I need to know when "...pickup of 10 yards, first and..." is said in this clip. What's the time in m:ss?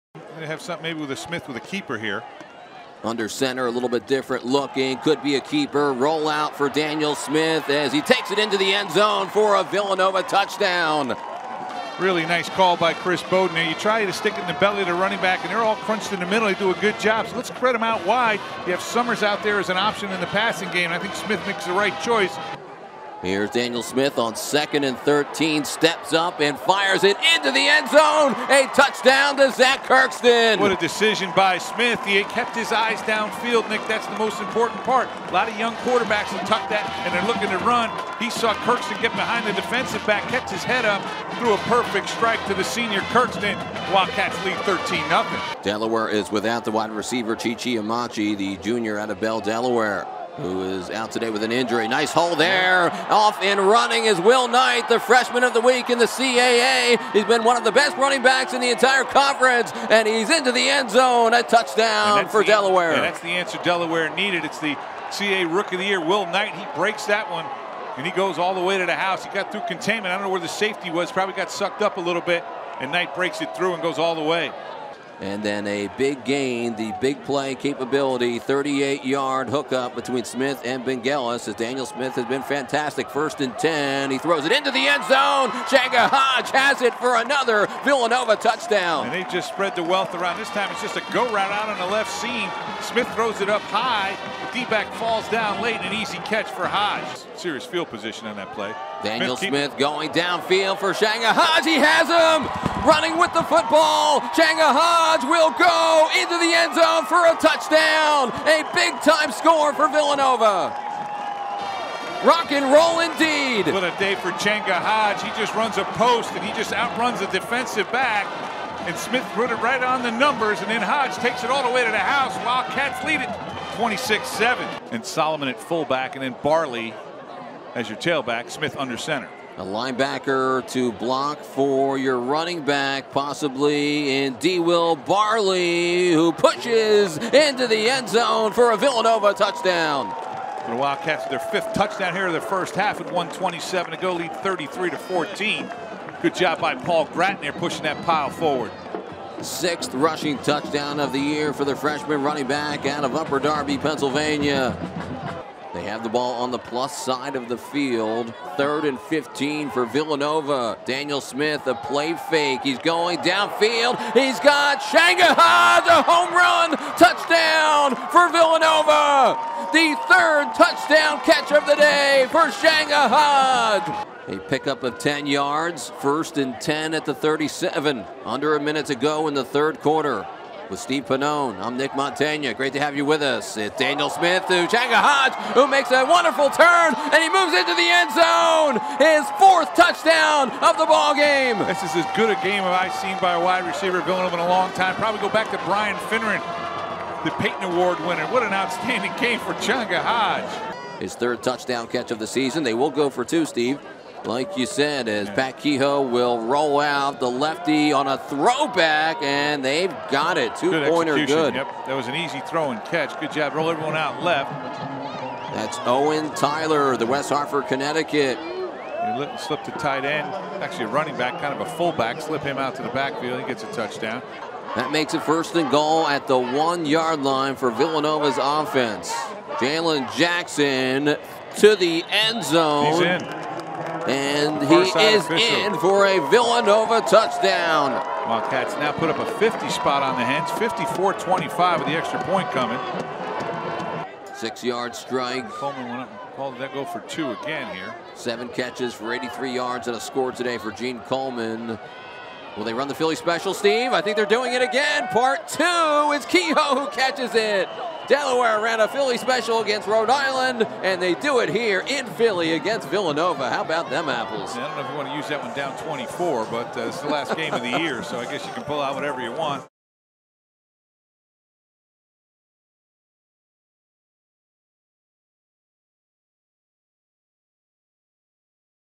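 2:54.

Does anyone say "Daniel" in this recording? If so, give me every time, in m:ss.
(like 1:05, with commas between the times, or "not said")
0:06, 0:23, 1:21, 1:39, 2:40, 3:03.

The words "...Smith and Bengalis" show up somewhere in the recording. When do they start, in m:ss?
1:20.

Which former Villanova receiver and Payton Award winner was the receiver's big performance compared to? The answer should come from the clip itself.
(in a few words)
Brian Finneran.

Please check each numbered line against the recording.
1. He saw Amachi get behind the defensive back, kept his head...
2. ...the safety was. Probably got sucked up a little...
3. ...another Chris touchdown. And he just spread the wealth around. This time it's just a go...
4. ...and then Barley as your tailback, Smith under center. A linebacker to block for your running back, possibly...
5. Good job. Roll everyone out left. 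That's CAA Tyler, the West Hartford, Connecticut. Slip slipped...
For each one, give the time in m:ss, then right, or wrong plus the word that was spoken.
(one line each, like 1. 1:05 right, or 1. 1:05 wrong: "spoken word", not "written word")
1. 0:38 wrong: "Kirkston", not "Amachi"
2. 1:10 right
3. 1:27 wrong: "Villanova", not "Chris"
4. 2:06 right
5. 3:33 wrong: "Owen", not "CAA".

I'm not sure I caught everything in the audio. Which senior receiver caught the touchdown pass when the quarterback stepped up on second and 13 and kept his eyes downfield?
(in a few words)
Zach Kirkston.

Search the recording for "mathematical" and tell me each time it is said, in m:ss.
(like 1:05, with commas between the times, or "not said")
not said.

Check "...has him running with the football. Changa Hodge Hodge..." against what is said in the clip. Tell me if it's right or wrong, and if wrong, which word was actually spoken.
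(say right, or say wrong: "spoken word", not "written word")
right.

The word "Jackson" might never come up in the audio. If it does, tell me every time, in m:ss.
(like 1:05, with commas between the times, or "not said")
3:50.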